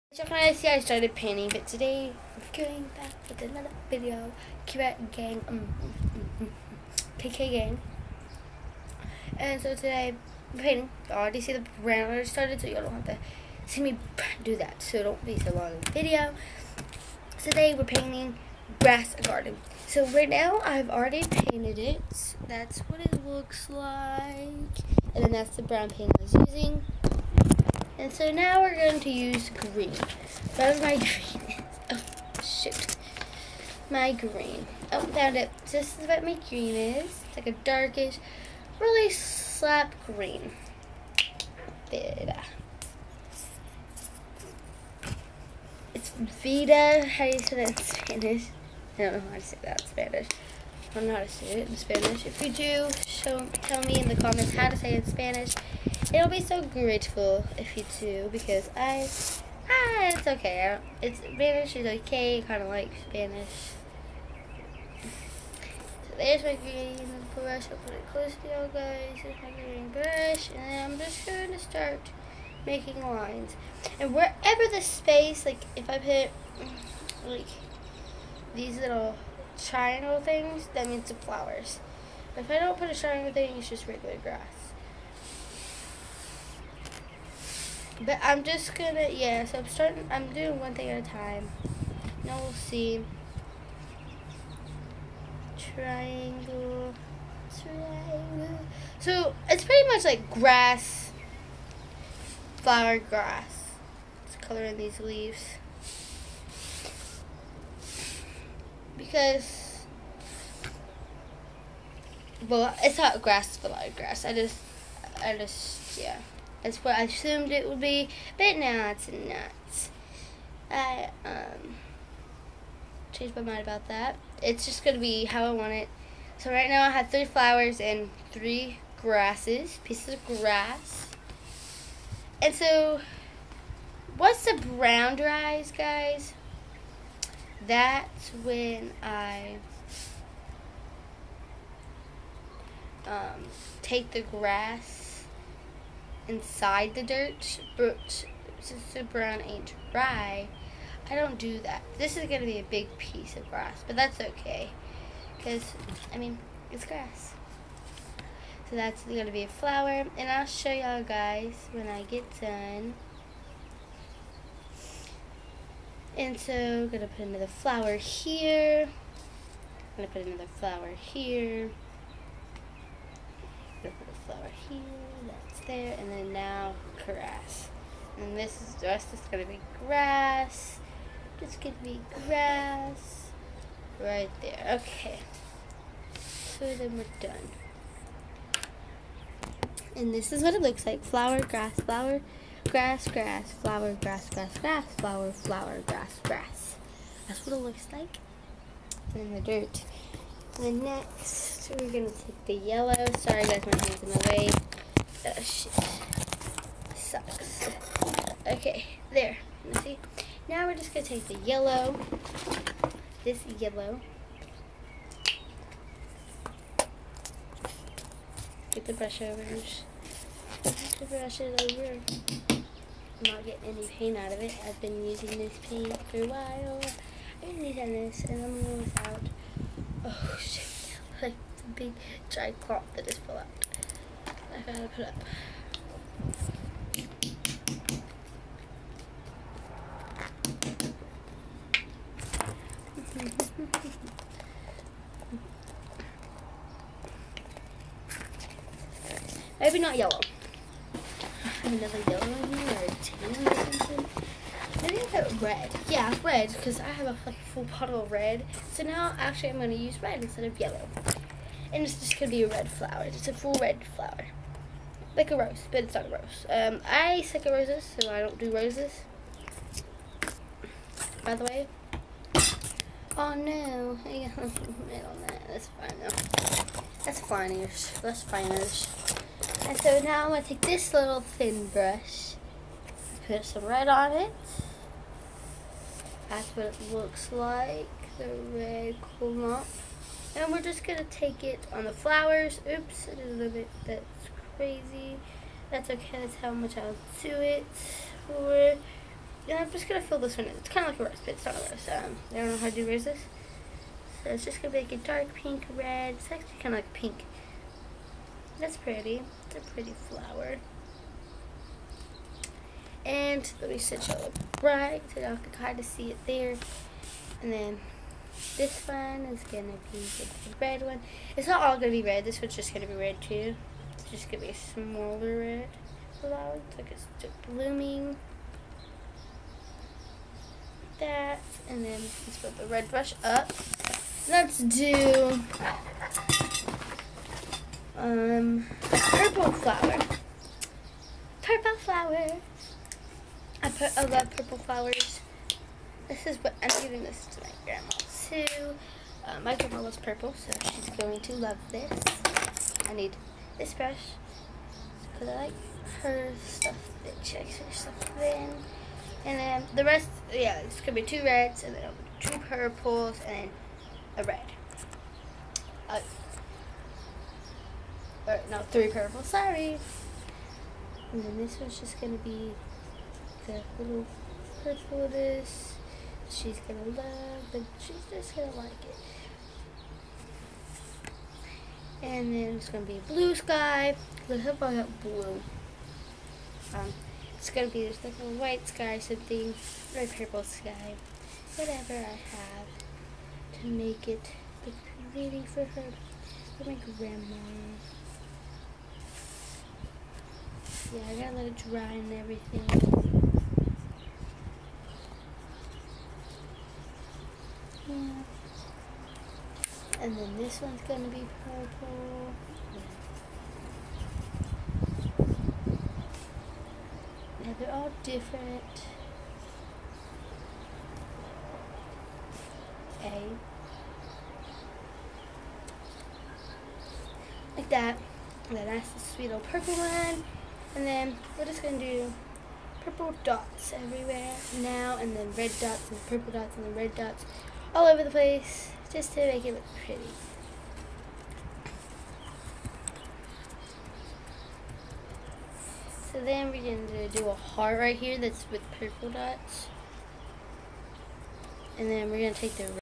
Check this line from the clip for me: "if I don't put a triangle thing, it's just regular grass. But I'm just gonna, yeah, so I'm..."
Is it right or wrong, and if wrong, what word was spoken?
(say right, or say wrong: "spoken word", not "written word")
right.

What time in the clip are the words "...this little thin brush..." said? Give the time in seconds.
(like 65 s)
280 s.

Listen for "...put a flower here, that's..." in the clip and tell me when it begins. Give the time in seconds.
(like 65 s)
173 s.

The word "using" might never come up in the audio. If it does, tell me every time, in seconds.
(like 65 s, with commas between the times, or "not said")
26 s, 225 s.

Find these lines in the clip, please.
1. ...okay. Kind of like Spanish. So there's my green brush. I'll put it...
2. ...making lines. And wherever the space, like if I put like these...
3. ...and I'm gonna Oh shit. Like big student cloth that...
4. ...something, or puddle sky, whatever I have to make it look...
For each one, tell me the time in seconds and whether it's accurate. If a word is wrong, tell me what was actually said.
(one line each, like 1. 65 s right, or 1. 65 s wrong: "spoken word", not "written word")
1. 62 s right
2. 72 s right
3. 228 s wrong: "giant", not "student"
4. 388 s wrong: "purple", not "puddle".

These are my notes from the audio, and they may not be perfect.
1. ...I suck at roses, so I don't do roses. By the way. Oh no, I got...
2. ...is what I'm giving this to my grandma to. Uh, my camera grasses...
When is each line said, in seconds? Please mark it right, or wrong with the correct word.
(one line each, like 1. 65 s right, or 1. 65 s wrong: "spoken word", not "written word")
1. 266 s right
2. 346 s wrong: "loves", not "grasses".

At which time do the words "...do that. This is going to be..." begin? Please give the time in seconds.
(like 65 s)
151 s.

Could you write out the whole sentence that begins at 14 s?
So don't be so long in the video.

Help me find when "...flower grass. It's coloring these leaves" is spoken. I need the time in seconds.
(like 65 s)
102 s.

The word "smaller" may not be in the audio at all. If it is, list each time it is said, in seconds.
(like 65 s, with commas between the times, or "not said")
324 s.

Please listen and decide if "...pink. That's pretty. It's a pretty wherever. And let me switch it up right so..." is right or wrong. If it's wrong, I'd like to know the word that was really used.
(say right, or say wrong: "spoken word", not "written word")
wrong: "flower", not "wherever".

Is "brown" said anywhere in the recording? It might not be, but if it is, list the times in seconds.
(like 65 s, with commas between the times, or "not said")
25 s, 134 s, 149 s.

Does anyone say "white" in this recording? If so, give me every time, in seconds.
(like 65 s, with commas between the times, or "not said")
388 s.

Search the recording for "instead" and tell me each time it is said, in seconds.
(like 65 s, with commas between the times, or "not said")
260 s.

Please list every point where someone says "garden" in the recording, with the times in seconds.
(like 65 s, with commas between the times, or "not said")
19 s.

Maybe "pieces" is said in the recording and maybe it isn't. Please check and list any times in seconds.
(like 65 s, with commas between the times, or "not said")
129 s, 152 s.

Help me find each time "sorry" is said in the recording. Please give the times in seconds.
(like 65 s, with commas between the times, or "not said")
203 s, 369 s.